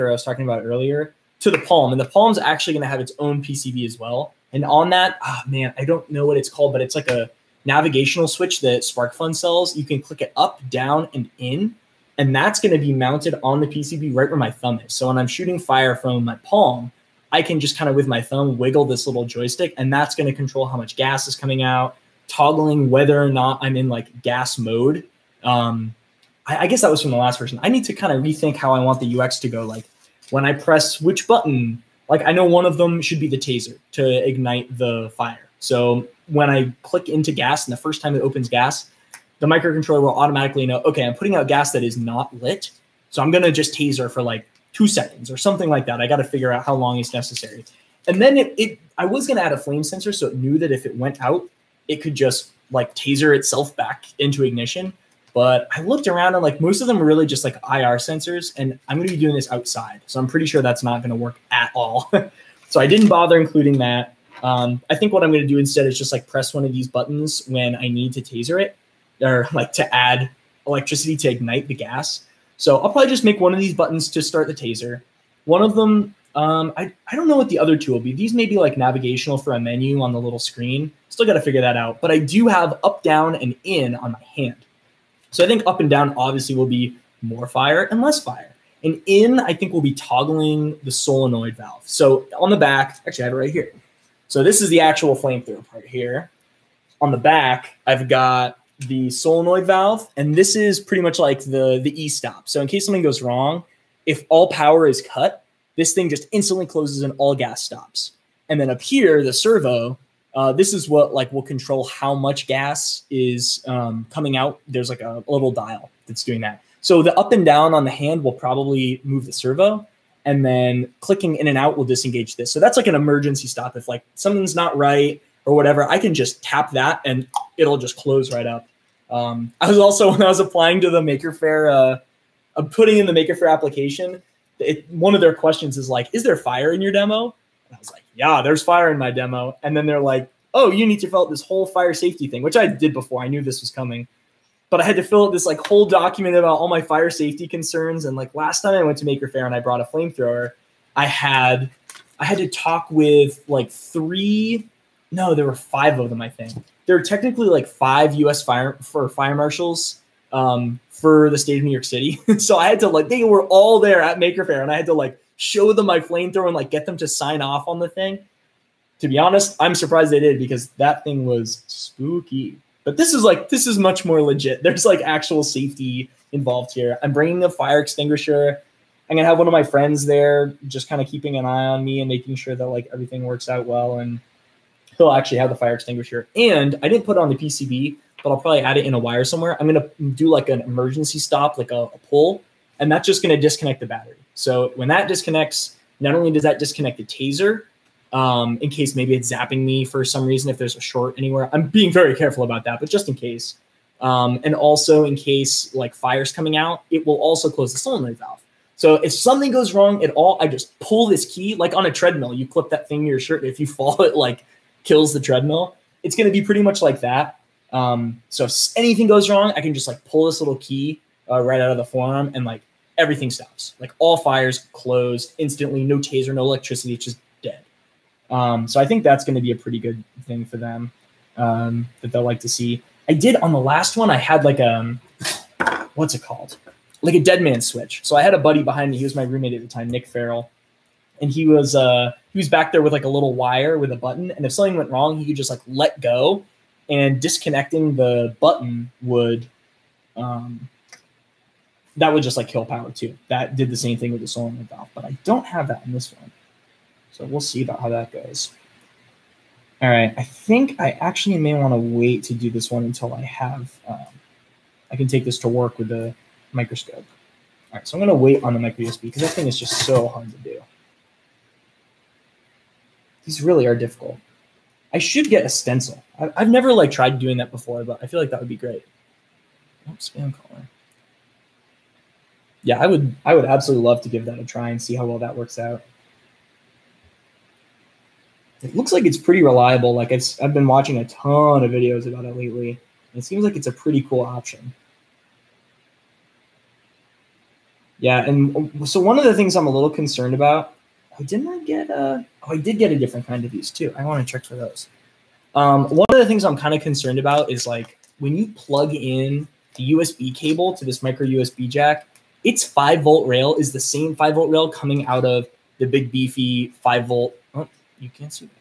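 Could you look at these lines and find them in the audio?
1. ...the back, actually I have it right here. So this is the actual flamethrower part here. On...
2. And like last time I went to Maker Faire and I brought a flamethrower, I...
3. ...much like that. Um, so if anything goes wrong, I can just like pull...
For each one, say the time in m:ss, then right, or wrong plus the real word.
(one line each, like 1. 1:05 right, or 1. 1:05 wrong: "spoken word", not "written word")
1. 1:32 right
2. 2:28 right
3. 3:36 right.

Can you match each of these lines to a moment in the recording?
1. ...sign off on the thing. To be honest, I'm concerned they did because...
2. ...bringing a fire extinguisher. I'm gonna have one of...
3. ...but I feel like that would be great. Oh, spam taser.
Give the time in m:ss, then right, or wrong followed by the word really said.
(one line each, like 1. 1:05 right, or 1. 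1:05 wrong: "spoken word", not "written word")
1. 2:47 wrong: "surprised", not "concerned"
2. 2:57 right
3. 4:37 wrong: "caller", not "taser".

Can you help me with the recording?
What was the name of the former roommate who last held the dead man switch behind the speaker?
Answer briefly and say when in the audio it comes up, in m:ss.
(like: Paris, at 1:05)
Nick Farrell, at 3:59.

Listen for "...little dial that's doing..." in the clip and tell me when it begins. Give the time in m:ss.
1:55.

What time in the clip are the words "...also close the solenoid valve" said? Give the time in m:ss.
3:27.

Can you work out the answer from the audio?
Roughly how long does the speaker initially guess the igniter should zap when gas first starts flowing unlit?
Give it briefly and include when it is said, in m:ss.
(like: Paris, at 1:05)
2 seconds, at 0:44.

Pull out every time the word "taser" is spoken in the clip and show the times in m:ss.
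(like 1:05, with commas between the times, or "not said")
0:33, 0:43, 0:52, 1:08, 1:14, 3:17, 3:45.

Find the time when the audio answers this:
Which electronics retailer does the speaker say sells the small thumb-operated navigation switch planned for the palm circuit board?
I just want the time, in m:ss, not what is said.
0:08.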